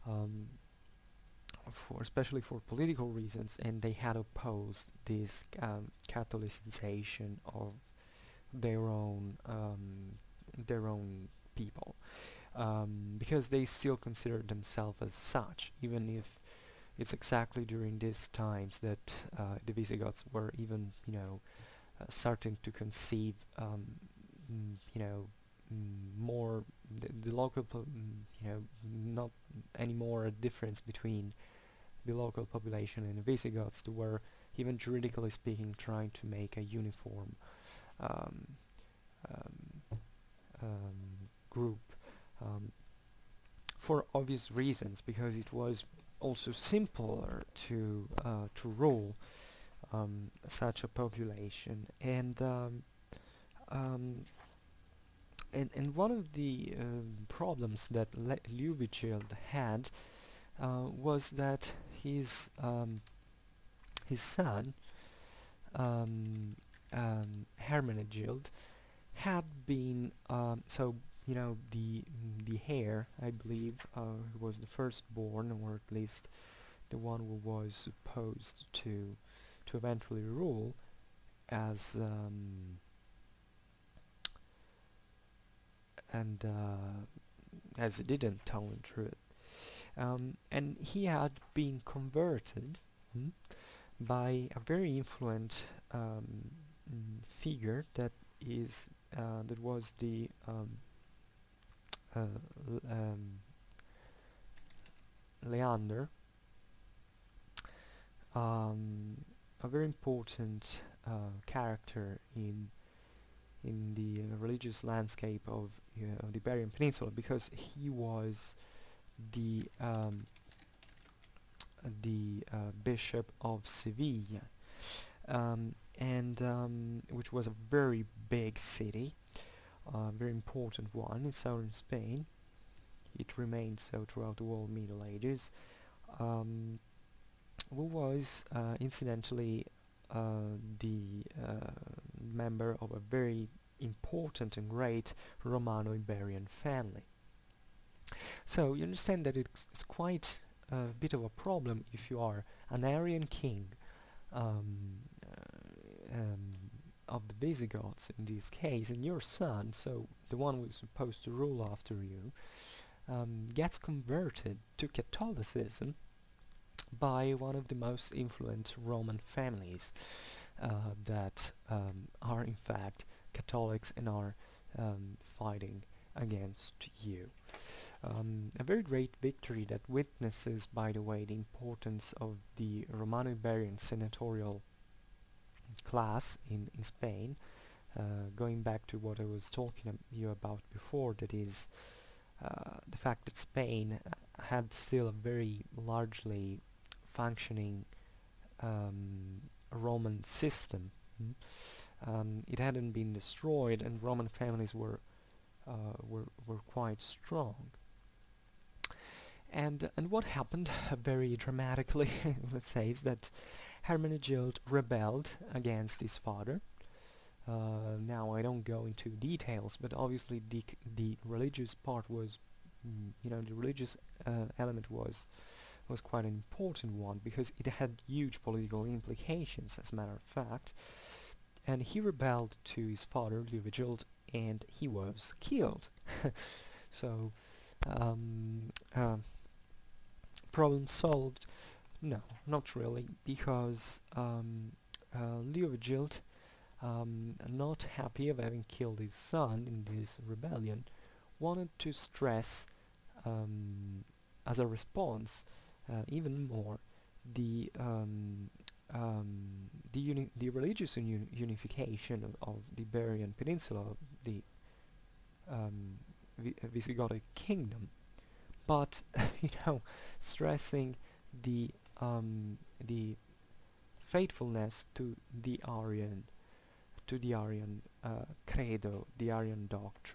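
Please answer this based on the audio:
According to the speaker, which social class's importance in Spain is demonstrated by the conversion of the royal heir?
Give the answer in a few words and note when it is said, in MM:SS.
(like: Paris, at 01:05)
Romano-Iberian senatorial class, at 03:02.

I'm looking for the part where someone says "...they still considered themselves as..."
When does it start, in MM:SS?
00:13.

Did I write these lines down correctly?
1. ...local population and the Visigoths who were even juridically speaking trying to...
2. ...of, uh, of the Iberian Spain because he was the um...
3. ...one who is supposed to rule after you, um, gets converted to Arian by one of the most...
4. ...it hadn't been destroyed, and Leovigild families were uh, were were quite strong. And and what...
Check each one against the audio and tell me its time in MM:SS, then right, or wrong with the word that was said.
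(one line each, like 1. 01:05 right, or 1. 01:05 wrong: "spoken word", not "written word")
1. 00:32 right
2. 01:55 wrong: "Peninsula", not "Spain"
3. 02:40 wrong: "Catholicism", not "Arian"
4. 03:22 wrong: "Roman", not "Leovigild".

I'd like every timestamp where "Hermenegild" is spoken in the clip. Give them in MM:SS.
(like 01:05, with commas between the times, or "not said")
01:07, 03:33.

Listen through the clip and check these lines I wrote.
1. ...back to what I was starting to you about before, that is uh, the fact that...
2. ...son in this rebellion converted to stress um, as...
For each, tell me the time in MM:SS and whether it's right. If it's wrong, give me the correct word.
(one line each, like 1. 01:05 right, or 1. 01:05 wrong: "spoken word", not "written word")
1. 03:08 wrong: "talking", not "starting"
2. 04:09 wrong: "wanted", not "converted".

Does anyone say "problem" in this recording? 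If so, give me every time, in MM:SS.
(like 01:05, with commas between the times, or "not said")
00:57, 02:31, 04:00.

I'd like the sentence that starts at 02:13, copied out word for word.
It remained so throughout the whole Middle Ages.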